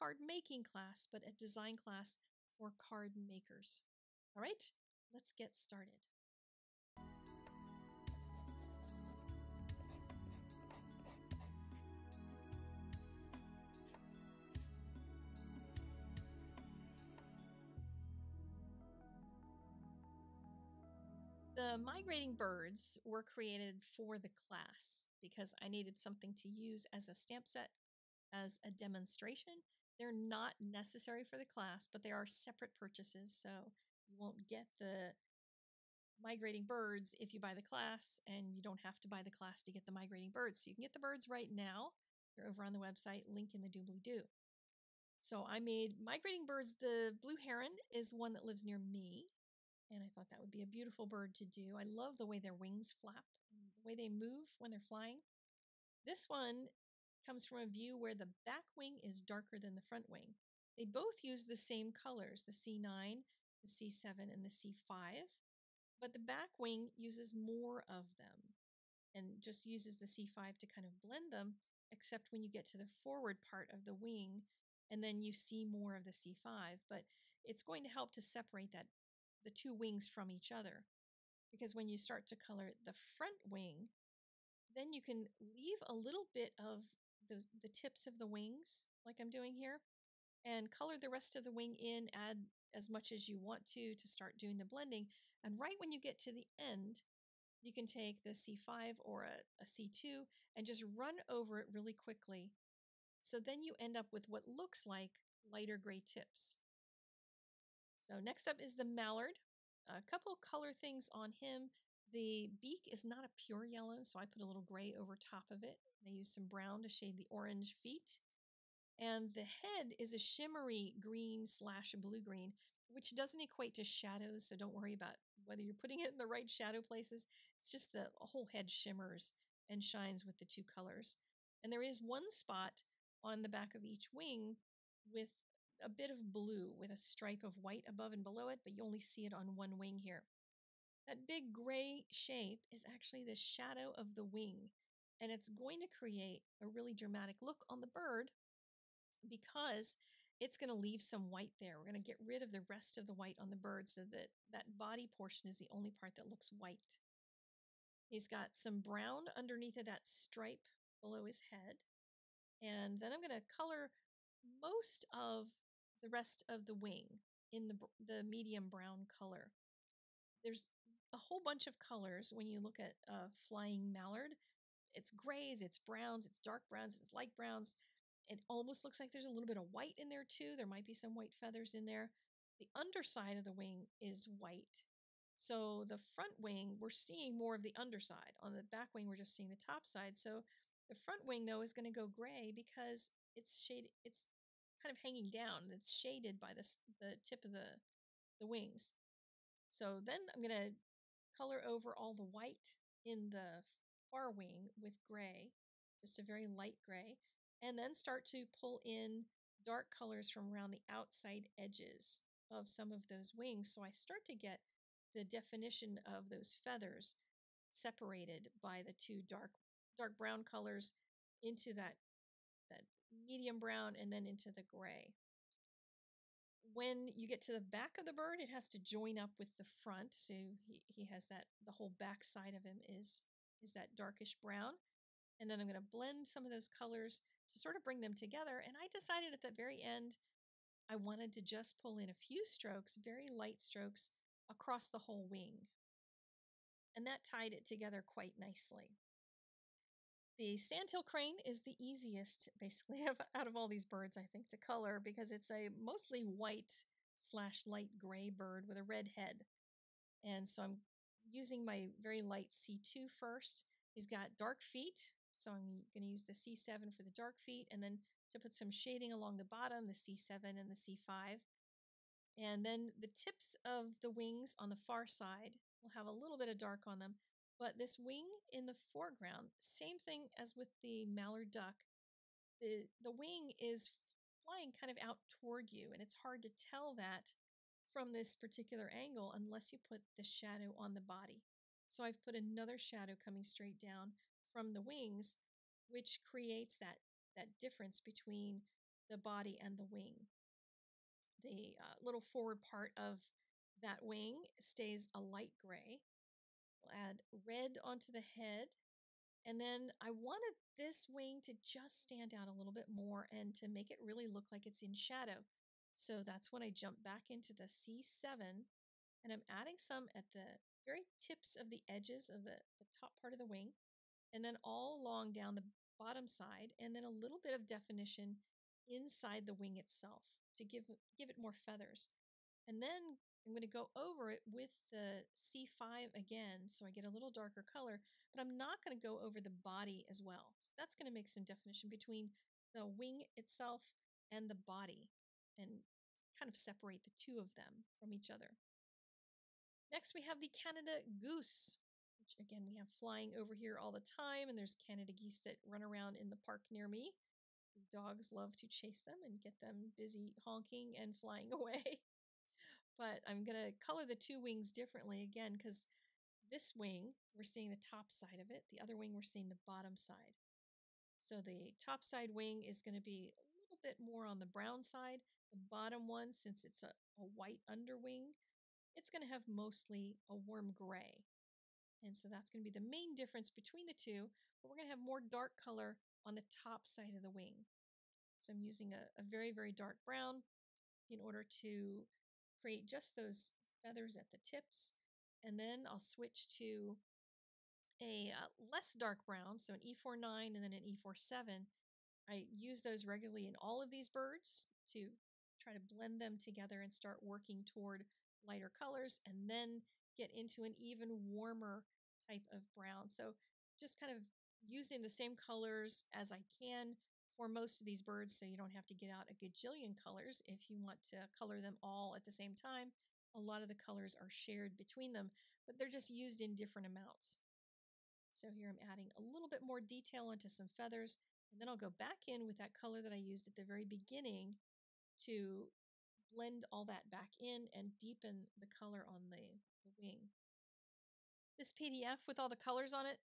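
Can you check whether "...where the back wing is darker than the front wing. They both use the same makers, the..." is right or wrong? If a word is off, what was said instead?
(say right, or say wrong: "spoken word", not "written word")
wrong: "colors", not "makers".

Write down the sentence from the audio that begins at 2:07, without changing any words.
It's just the whole head shimmers and shines with the two colors.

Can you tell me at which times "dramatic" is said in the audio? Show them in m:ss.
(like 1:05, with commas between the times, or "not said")
2:26.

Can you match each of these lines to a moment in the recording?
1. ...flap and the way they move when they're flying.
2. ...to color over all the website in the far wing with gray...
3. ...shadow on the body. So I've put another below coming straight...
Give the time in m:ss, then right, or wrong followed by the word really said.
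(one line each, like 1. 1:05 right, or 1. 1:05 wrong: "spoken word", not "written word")
1. 0:52 right
2. 3:20 wrong: "white", not "website"
3. 4:50 wrong: "shadow", not "below".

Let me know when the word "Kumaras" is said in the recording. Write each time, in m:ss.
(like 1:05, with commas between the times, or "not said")
not said.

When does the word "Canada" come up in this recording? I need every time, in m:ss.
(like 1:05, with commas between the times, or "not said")
5:50, 5:54.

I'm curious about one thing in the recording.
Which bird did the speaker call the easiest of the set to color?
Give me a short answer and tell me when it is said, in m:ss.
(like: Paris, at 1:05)
Sandhill crane, at 4:10.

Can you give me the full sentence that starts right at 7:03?
A lot of the colors are shared between them, but they're just used in different amounts.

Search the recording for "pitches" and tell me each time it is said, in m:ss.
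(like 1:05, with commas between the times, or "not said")
not said.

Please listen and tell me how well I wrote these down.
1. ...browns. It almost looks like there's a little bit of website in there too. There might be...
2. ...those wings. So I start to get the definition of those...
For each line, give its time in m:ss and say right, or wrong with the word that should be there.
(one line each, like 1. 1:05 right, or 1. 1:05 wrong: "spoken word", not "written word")
1. 2:57 wrong: "white", not "website"
2. 3:33 right.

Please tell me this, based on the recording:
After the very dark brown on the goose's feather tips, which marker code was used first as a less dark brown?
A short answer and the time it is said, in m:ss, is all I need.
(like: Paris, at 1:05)
E49, at 6:39.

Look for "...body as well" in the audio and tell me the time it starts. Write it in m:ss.
5:39.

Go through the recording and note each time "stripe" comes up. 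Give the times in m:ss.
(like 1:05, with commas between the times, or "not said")
2:16, 2:40.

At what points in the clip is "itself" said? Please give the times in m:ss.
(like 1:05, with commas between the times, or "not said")
5:29, 5:43.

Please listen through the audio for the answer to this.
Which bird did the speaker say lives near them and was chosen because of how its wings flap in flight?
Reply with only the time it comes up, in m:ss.
0:47.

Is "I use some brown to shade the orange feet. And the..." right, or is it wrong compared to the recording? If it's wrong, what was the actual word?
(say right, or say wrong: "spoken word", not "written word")
right.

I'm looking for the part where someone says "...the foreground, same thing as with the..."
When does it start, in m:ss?
4:38.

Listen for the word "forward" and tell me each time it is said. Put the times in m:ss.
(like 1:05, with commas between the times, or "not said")
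1:12, 5:02.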